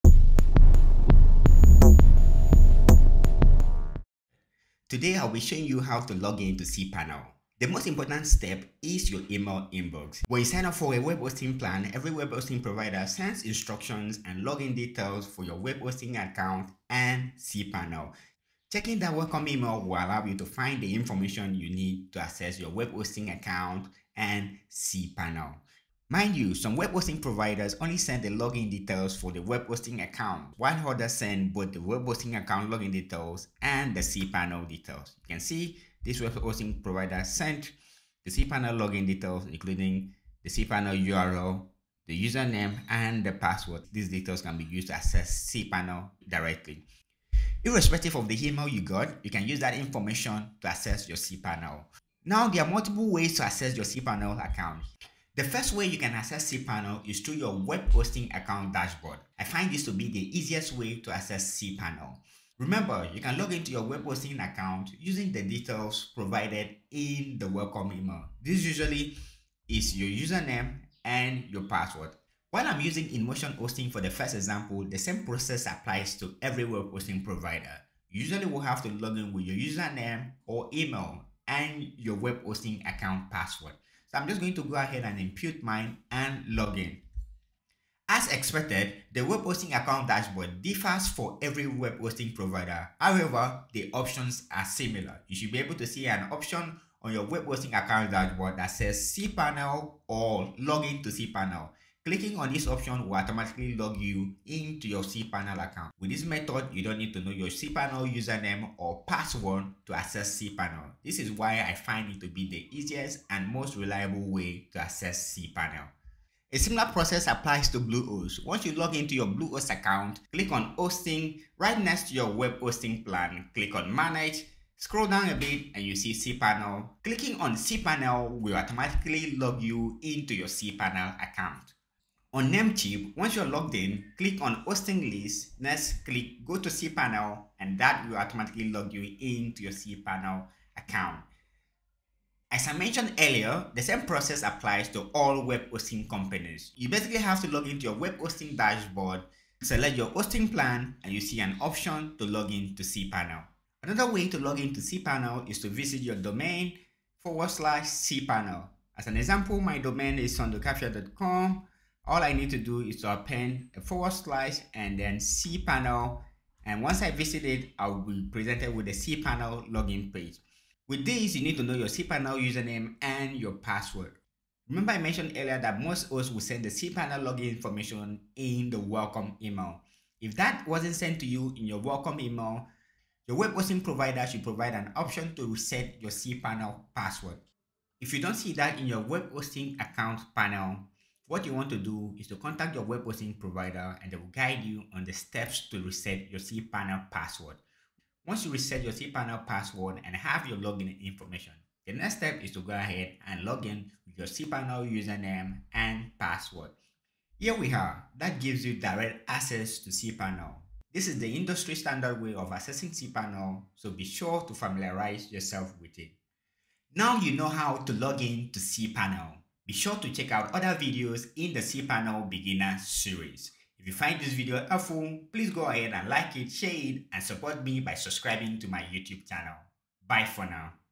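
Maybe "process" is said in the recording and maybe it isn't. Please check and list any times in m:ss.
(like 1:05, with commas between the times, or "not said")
1:15, 1:56, 2:24.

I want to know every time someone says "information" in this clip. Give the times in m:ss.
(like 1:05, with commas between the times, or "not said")
0:20, 0:49, 2:57, 3:21.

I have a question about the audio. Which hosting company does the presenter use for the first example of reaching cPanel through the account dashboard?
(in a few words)
InMotion hosting.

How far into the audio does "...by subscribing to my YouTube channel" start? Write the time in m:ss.
3:47.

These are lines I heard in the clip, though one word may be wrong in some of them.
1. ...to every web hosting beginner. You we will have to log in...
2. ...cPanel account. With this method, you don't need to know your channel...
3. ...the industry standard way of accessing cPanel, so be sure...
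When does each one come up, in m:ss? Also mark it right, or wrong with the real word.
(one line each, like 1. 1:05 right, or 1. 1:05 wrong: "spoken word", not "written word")
1. 1:16 wrong: "provider", not "beginner"
2. 1:45 wrong: "cPanel", not "channel"
3. 3:31 right.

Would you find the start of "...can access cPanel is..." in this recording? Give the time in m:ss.
0:55.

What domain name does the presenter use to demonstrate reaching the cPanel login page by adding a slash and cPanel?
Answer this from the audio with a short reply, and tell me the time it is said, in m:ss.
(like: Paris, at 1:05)
sundayukafia.com, at 2:40.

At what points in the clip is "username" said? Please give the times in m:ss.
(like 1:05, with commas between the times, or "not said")
0:42, 1:10, 1:19, 1:48, 2:52, 3:24.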